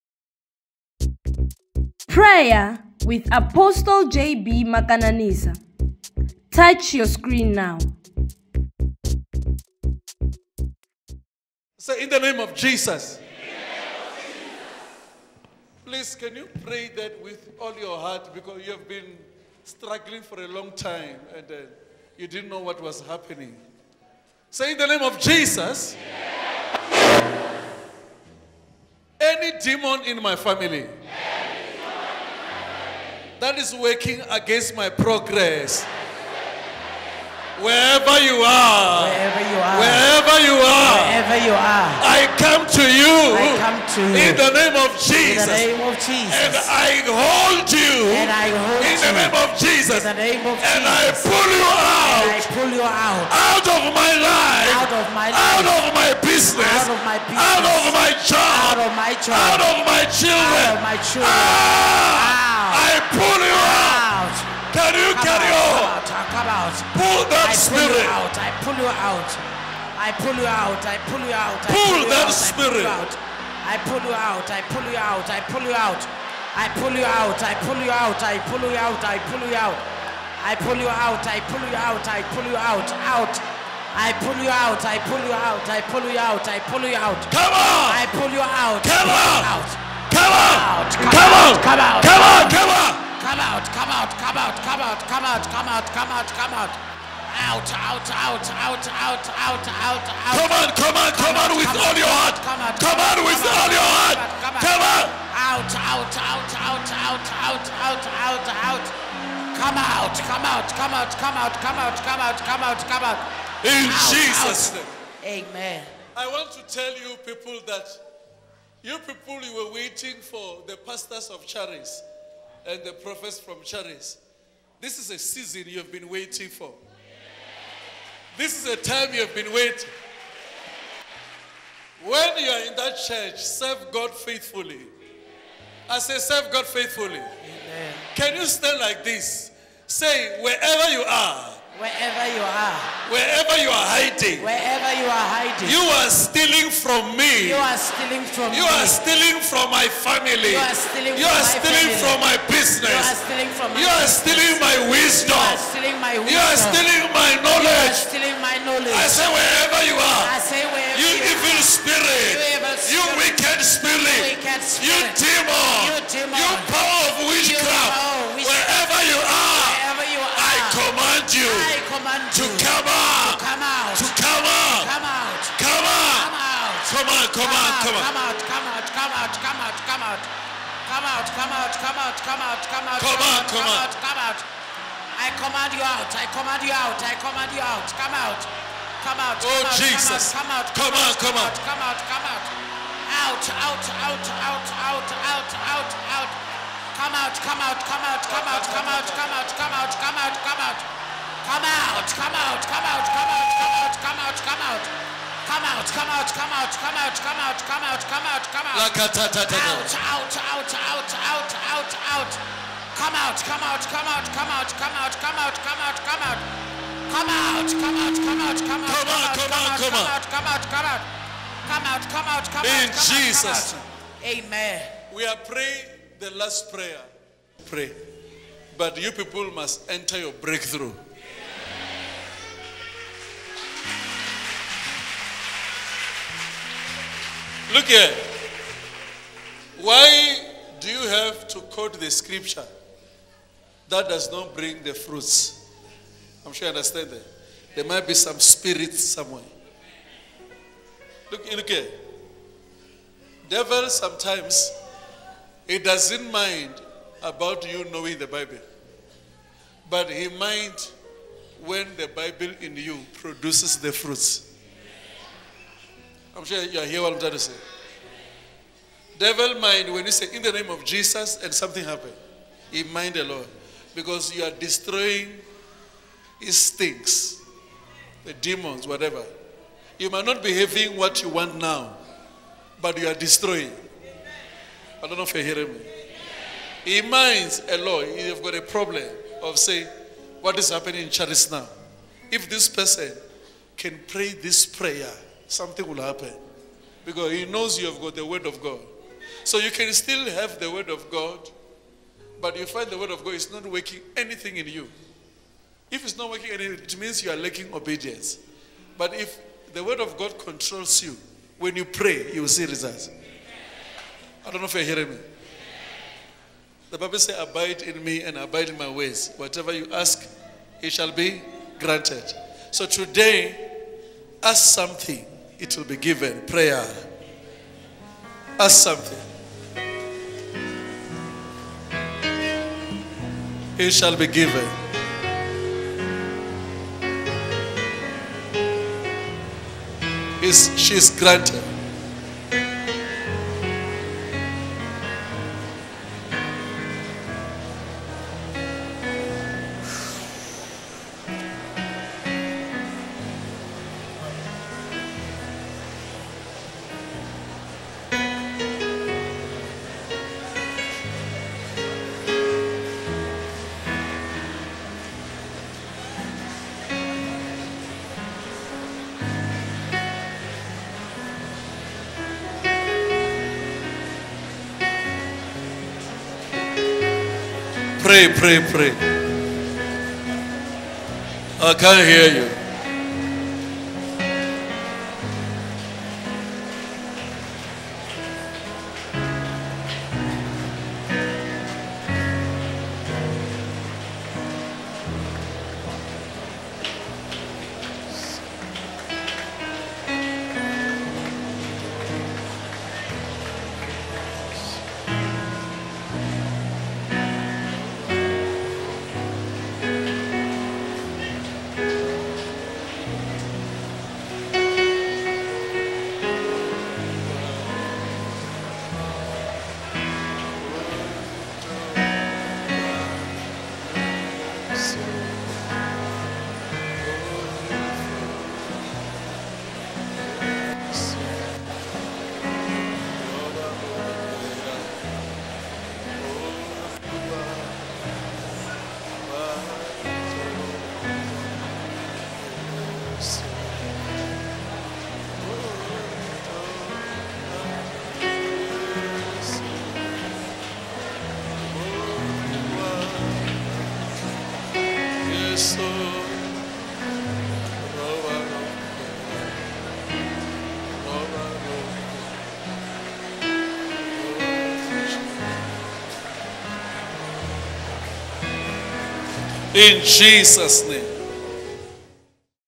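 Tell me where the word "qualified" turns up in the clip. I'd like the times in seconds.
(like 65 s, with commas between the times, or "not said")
not said.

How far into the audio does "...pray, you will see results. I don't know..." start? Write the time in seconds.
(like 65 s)
311 s.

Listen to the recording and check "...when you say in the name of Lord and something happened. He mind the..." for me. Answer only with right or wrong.
wrong.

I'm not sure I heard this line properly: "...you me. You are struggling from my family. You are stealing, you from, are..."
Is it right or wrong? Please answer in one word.
wrong.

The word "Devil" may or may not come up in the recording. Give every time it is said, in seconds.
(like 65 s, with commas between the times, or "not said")
253 s, 269 s.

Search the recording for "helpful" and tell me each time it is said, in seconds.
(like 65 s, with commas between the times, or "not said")
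not said.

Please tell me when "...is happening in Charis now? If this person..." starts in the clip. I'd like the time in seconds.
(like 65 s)
290 s.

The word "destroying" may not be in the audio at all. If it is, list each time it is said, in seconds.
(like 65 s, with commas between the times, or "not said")
274 s, 283 s.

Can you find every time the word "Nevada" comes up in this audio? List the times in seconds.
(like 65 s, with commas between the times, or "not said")
not said.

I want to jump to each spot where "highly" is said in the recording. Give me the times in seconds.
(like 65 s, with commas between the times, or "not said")
not said.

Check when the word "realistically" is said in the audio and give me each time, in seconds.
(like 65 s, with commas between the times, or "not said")
not said.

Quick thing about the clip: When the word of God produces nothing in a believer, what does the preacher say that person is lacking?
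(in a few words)
Obedience.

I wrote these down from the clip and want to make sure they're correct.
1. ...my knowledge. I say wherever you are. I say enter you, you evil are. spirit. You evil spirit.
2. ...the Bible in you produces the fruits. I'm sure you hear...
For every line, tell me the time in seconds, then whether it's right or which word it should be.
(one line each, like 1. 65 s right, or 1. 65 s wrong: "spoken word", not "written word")
1. 158 s wrong: "wherever", not "enter"
2. 261 s right.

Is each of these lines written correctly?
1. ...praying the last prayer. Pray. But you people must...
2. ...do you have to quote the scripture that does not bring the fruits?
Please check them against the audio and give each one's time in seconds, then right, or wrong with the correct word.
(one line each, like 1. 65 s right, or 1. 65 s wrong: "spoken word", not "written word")
1. 225 s right
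2. 240 s right.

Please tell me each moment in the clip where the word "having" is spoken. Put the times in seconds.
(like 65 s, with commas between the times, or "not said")
280 s.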